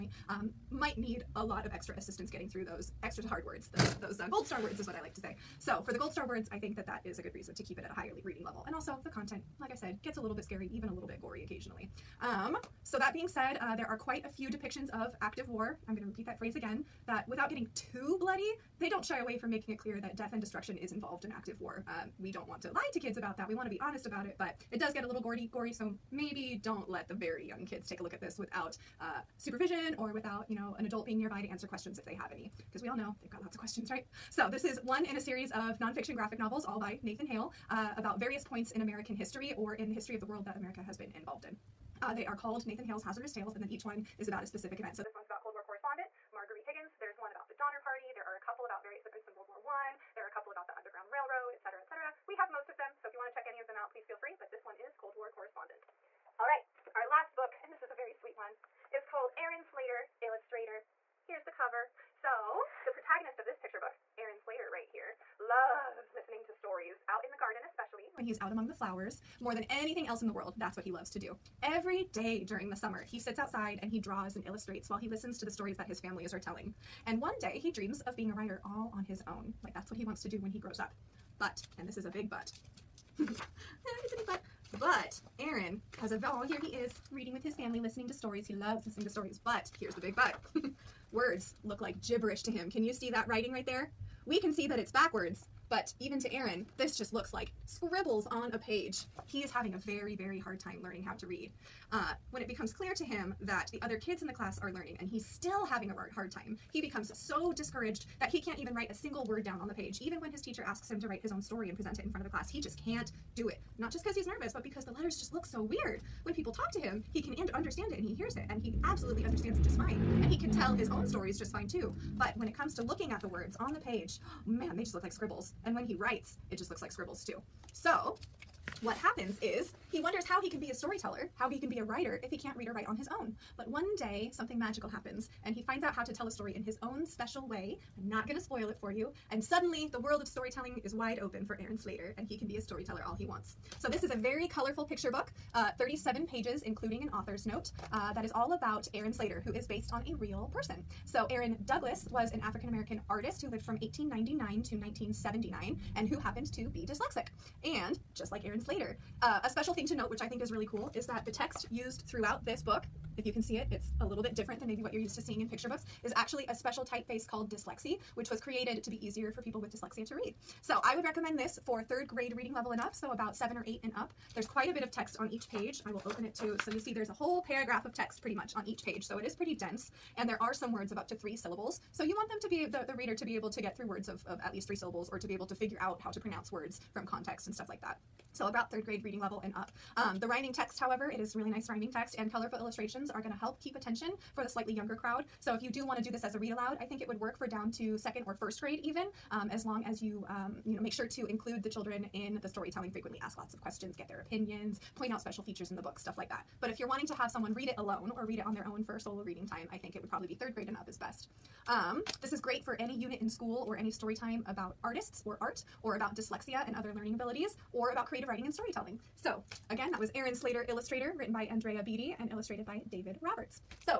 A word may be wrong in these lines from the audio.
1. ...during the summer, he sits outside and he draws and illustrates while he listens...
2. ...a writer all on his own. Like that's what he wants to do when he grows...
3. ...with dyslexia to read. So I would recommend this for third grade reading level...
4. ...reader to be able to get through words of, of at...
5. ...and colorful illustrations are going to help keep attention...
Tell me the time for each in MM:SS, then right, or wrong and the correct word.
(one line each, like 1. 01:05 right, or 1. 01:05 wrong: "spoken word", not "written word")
1. 01:12 right
2. 01:18 right
3. 02:49 right
4. 03:02 right
5. 03:12 right.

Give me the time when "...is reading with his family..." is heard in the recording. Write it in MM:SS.
01:26.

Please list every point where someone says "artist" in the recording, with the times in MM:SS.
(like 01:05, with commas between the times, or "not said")
02:33, 03:34.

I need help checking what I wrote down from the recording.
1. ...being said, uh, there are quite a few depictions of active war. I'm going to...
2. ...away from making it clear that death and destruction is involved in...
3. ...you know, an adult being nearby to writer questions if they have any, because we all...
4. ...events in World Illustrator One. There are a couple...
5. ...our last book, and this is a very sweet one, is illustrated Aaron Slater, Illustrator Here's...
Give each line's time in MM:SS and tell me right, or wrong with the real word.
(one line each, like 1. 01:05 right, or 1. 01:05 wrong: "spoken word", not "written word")
1. 00:13 right
2. 00:19 right
3. 00:30 wrong: "answer", not "writer"
4. 00:49 wrong: "War", not "Illustrator"
5. 00:56 wrong: "called", not "illustrated".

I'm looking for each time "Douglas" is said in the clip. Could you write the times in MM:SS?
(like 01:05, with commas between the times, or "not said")
02:31.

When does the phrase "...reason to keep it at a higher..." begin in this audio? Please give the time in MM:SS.
00:07.